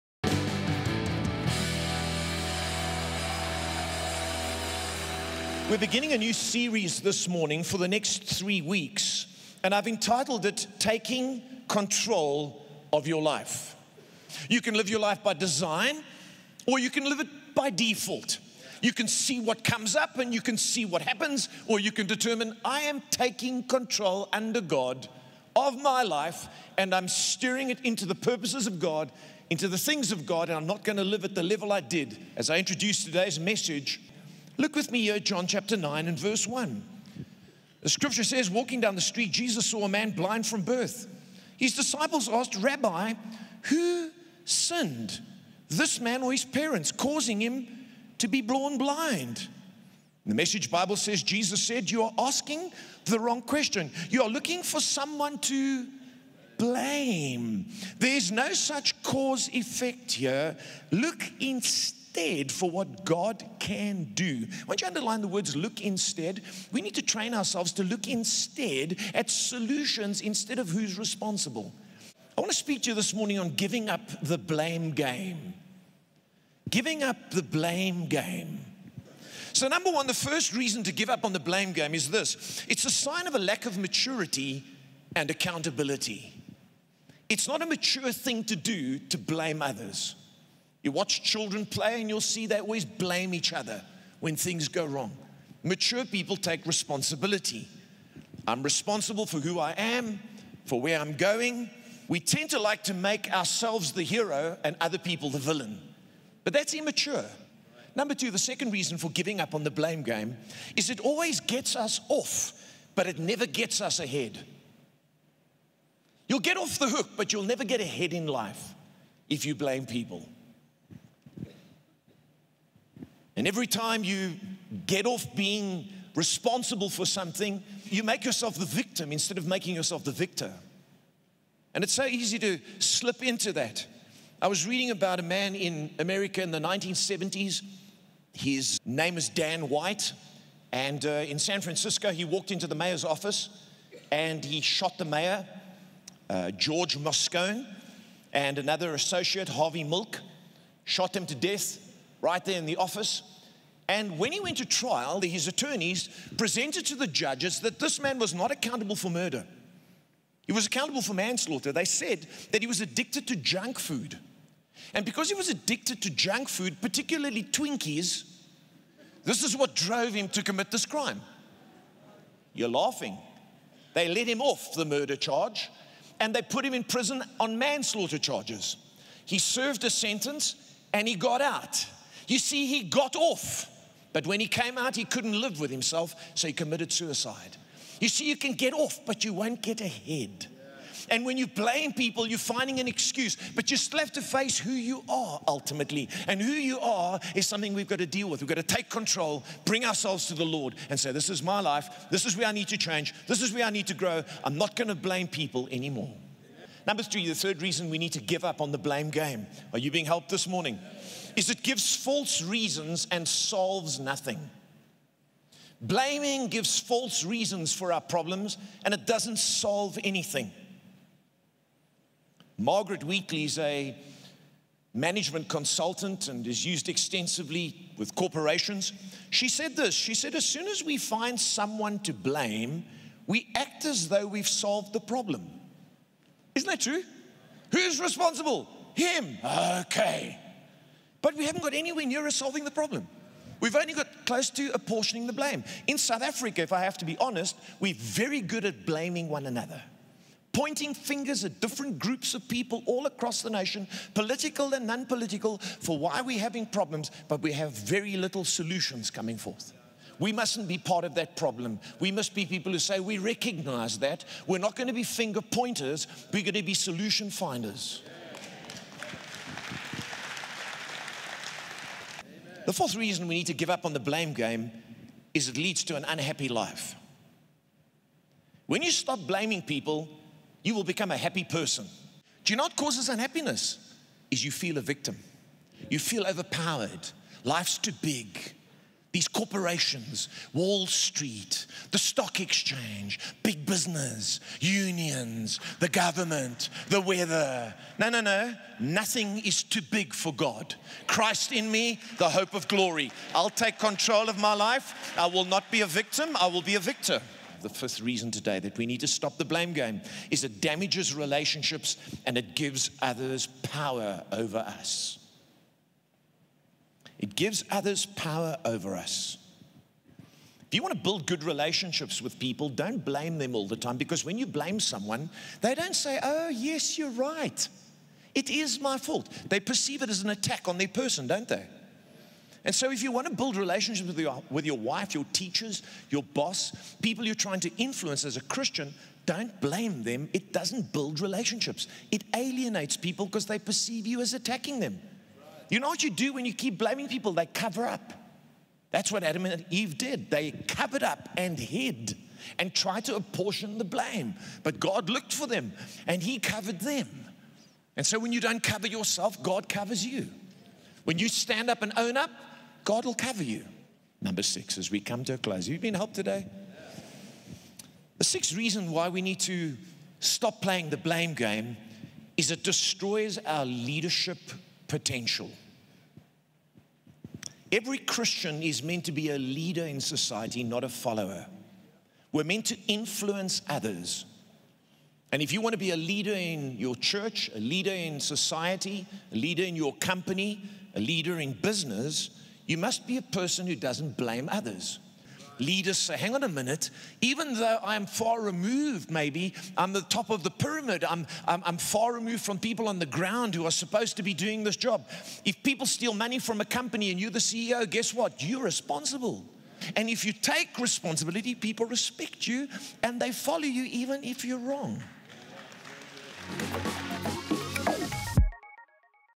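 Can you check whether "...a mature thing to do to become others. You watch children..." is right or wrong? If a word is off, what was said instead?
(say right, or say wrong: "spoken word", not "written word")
wrong: "blame", not "become".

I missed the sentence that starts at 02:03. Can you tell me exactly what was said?
And every time you get off being responsible for something, you make yourself the victim instead of making yourself the victor.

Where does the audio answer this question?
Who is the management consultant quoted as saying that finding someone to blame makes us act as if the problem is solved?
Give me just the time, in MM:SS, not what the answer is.
03:42.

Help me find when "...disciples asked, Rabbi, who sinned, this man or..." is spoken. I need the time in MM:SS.
00:41.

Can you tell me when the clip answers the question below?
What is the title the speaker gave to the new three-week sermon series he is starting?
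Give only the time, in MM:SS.
00:10.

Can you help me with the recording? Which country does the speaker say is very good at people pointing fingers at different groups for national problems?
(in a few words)
South Africa.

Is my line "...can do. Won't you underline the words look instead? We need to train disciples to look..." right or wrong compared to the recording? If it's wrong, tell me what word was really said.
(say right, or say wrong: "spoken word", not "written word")
wrong: "ourselves", not "disciples".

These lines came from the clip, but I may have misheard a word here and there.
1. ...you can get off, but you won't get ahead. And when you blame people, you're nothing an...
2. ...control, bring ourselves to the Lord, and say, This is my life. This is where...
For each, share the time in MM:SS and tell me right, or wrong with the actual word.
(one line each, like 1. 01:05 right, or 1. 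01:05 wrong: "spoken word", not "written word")
1. 03:08 wrong: "finding", not "nothing"
2. 03:18 right.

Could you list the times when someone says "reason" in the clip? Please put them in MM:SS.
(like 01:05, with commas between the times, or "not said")
01:20, 01:48, 03:27, 03:32, 03:37, 04:32, 05:08, 06:08.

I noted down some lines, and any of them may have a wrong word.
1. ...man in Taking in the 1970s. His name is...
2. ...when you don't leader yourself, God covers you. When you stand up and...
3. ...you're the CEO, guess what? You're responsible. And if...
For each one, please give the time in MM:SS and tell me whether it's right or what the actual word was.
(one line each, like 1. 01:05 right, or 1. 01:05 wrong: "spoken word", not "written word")
1. 02:15 wrong: "America", not "Taking"
2. 05:58 wrong: "cover", not "leader"
3. 06:47 right.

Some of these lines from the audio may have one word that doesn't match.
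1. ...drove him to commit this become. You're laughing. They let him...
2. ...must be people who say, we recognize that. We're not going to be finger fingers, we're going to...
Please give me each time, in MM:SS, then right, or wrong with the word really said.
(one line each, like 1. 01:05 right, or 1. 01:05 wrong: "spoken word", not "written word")
1. 02:49 wrong: "crime", not "become"
2. 04:22 wrong: "pointers", not "fingers".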